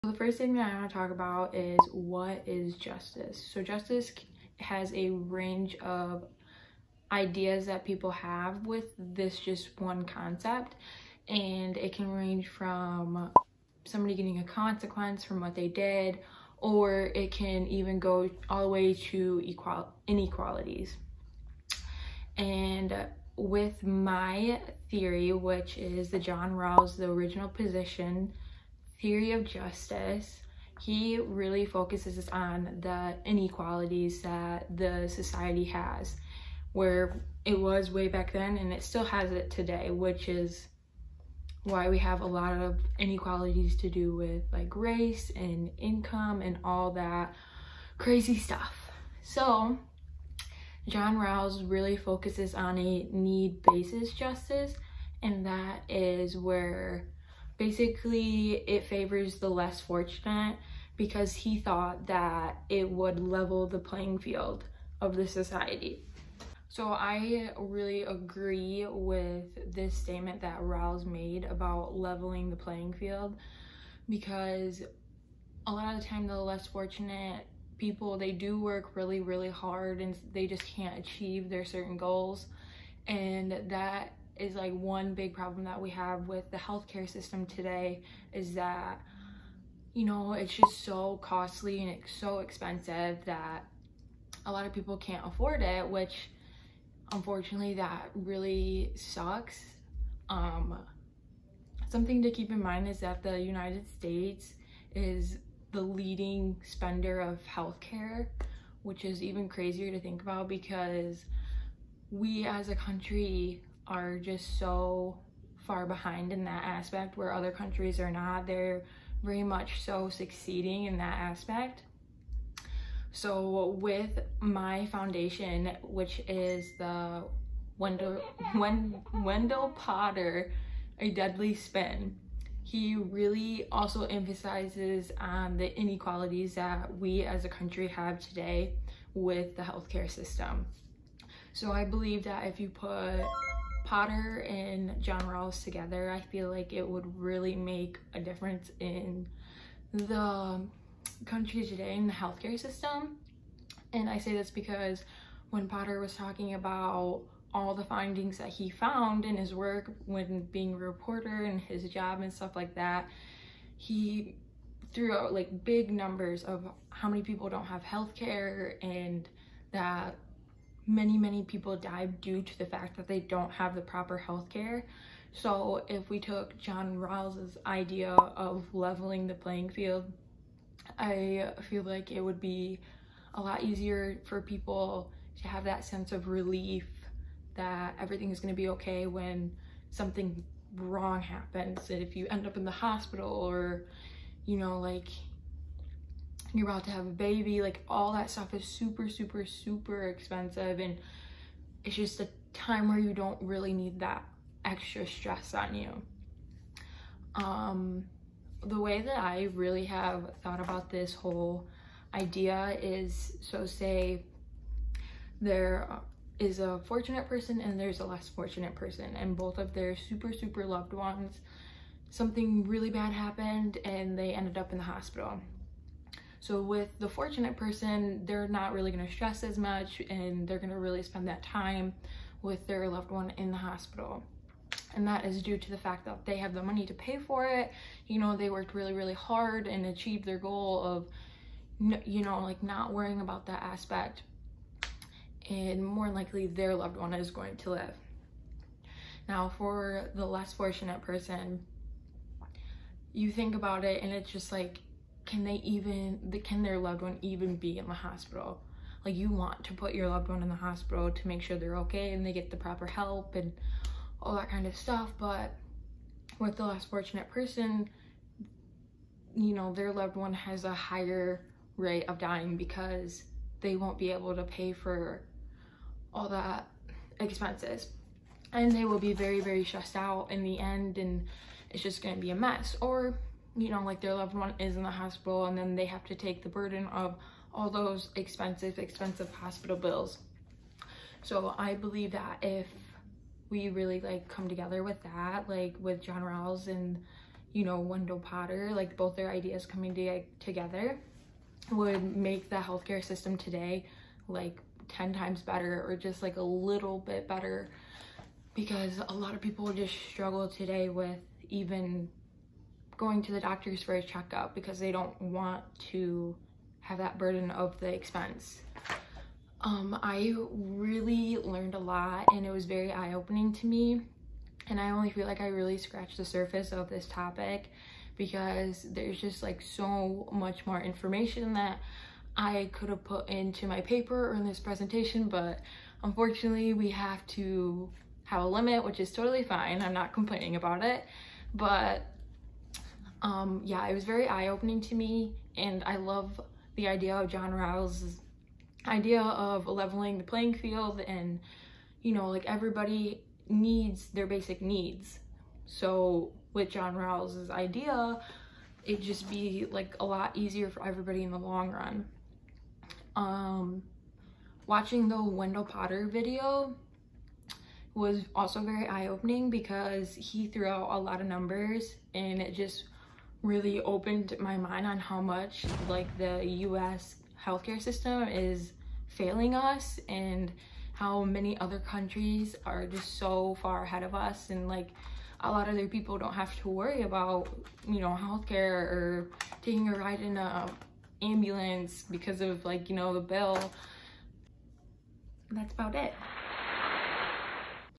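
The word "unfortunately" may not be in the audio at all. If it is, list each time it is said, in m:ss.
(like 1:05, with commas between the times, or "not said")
1:37, 5:36.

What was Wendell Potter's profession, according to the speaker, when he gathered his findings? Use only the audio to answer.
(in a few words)
reporter.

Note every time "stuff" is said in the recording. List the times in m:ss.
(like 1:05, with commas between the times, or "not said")
0:48, 2:42, 3:18, 4:24.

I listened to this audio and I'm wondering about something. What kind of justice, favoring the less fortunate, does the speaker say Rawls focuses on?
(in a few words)
need basis justice.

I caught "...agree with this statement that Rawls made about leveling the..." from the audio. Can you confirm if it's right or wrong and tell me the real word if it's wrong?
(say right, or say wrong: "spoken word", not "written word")
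right.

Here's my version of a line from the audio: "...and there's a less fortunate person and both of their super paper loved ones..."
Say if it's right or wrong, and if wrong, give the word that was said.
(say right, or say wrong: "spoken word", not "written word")
wrong: "super", not "paper".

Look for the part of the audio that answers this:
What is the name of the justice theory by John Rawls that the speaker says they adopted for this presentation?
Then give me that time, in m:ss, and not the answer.
0:27.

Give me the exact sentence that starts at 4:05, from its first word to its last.
And more likely their loved one is going to live.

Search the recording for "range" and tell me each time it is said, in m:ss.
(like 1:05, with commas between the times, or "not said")
0:05, 0:12.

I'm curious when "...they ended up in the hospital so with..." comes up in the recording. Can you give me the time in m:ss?
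3:44.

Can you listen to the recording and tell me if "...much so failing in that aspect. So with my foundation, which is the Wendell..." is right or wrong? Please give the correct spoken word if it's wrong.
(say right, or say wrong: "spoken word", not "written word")
wrong: "succeeding", not "failing".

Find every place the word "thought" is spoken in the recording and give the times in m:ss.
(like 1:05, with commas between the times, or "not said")
1:01, 3:30.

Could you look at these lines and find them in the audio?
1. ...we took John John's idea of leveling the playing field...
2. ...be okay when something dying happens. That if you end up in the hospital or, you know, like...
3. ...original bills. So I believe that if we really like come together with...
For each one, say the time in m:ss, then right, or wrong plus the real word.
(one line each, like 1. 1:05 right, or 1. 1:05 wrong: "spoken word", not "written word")
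1. 2:56 wrong: "Rawls", not "John"
2. 3:08 wrong: "wrong", not "dying"
3. 4:49 wrong: "hospital", not "original".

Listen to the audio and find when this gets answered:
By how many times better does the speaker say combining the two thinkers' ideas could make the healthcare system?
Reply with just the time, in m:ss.
5:04.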